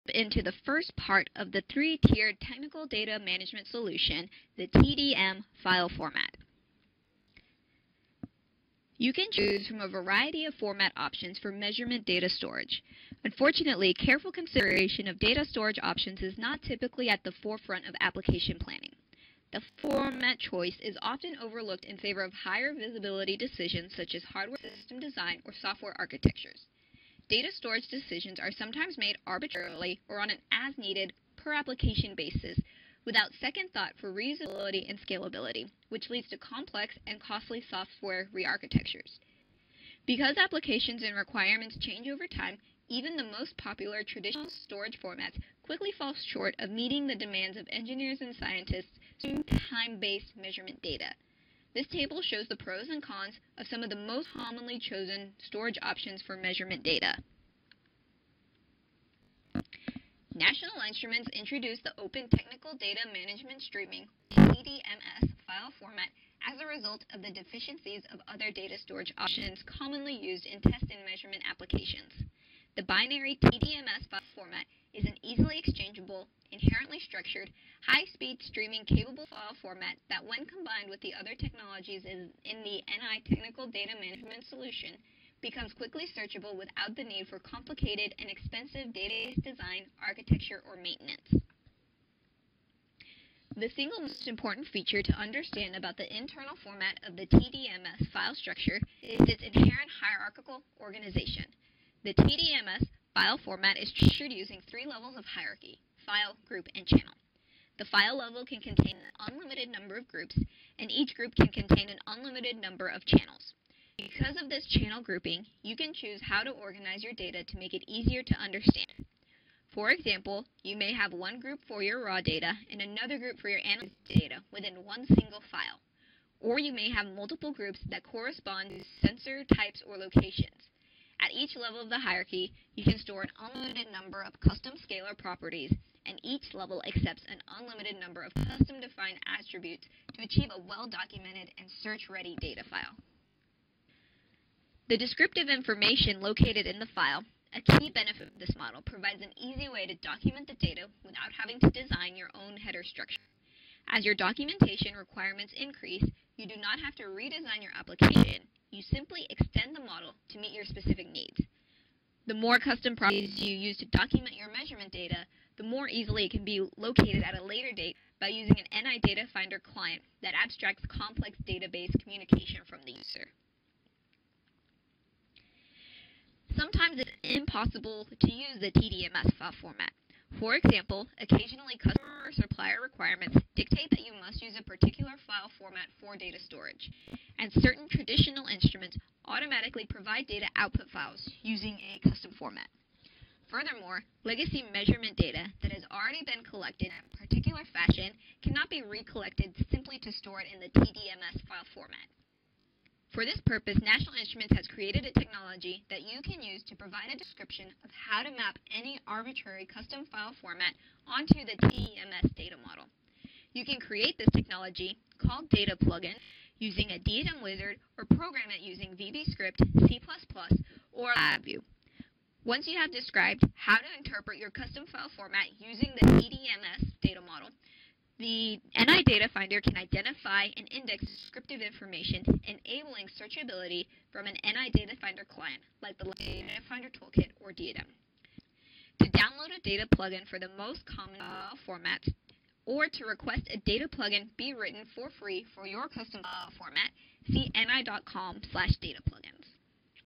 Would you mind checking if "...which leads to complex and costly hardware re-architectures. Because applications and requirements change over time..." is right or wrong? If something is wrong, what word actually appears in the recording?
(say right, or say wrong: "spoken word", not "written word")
wrong: "software", not "hardware".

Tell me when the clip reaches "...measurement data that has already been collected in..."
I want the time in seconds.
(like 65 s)
194 s.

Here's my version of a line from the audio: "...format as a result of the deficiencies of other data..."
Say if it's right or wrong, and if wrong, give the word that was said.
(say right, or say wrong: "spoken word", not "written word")
right.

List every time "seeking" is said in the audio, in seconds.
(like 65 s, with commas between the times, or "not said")
49 s.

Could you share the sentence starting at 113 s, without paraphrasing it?
Because of this channel grouping, you can choose how to organize your data to make it easier to understand.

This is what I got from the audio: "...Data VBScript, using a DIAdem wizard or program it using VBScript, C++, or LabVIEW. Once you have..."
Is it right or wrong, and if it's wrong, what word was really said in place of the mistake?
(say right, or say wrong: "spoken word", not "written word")
wrong: "Plugin", not "VBScript".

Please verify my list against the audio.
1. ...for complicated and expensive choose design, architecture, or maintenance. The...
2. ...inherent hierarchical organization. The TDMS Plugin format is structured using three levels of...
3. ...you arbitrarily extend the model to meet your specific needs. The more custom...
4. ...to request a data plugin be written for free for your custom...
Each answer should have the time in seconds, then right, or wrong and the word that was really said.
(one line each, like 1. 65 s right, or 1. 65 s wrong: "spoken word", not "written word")
1. 87 s wrong: "database", not "choose"
2. 99 s wrong: "File", not "Plugin"
3. 158 s wrong: "simply", not "arbitrarily"
4. 242 s right.